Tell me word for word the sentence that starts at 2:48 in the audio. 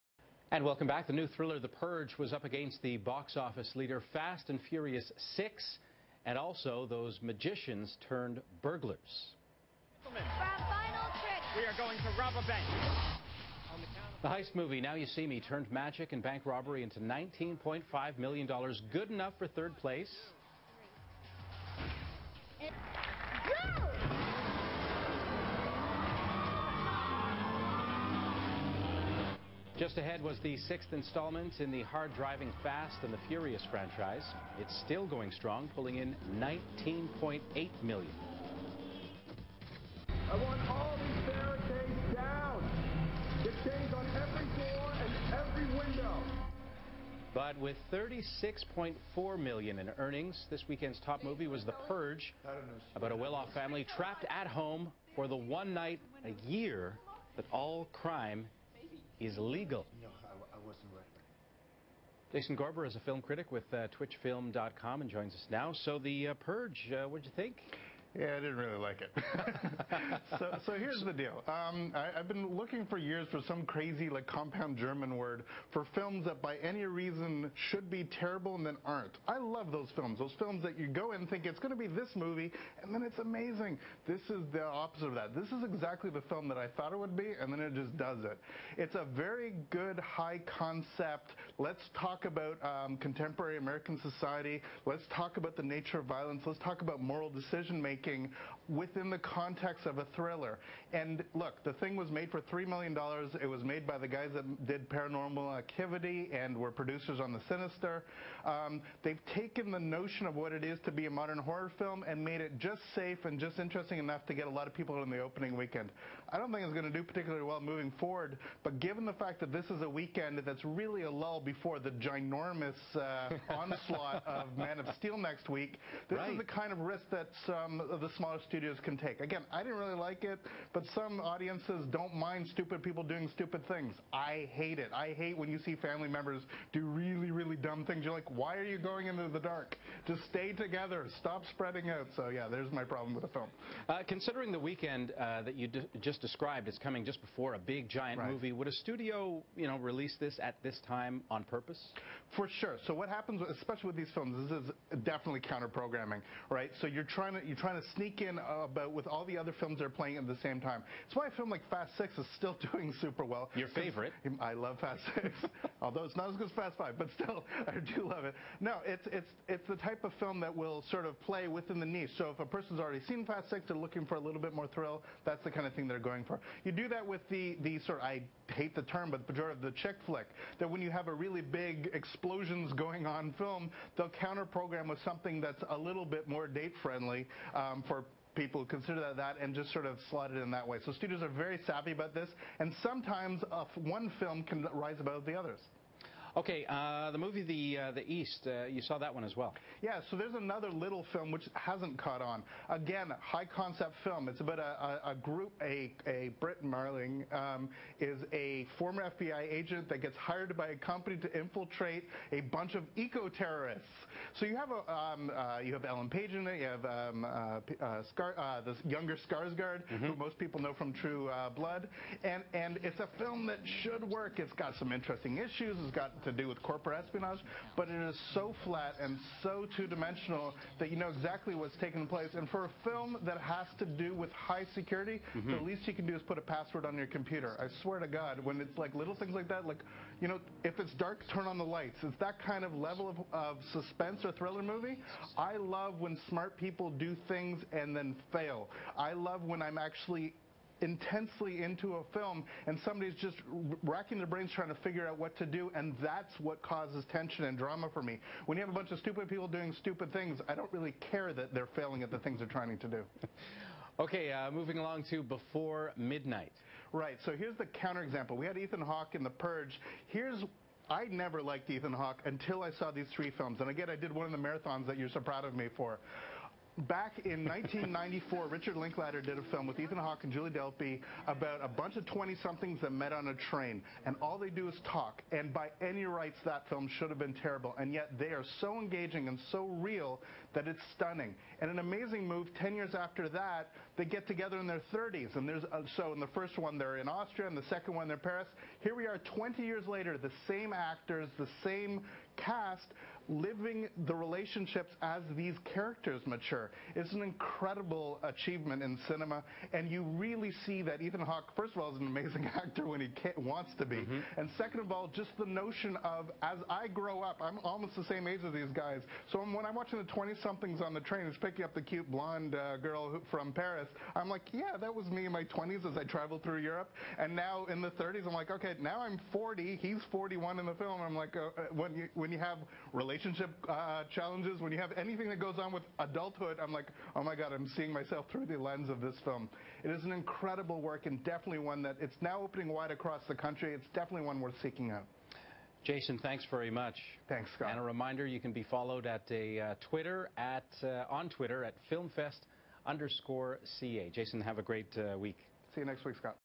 No, it's it's it's the type of film that will sort of play within the niche.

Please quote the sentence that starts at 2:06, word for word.
is the kind of risk that some um, of the smaller studios studios can take.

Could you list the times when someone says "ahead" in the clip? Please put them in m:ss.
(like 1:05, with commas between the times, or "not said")
0:29.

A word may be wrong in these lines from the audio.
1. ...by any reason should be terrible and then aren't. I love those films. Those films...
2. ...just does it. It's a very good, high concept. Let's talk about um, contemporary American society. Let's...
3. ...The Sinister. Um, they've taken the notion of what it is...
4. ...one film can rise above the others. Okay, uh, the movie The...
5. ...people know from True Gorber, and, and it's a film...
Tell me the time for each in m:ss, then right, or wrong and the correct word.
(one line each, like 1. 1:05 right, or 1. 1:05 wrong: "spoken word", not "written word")
1. 1:16 right
2. 1:27 right
3. 1:47 right
4. 3:13 right
5. 3:40 wrong: "Blood", not "Gorber".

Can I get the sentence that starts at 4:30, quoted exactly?
Here's I never liked Ethan Hawke until I saw these three films.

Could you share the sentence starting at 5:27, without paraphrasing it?
And now in the 30s, I'm like, okay, now I'm 40.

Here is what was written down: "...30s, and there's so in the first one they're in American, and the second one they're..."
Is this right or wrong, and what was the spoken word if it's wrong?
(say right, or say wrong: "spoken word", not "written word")
wrong: "Austria", not "American".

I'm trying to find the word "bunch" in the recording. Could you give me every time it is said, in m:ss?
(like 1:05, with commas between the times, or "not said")
3:32, 4:18, 4:41.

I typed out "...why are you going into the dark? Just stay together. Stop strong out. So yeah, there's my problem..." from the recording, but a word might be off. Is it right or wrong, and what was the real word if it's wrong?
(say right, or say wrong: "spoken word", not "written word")
wrong: "spreading", not "strong".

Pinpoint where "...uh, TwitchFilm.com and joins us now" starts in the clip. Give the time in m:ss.
1:03.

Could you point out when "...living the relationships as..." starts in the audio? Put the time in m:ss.
5:03.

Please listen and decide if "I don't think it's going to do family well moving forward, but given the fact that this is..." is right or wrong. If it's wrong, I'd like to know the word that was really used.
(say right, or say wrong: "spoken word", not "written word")
wrong: "particularly", not "family".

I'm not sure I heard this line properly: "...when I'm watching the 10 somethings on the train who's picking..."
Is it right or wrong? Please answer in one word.
wrong.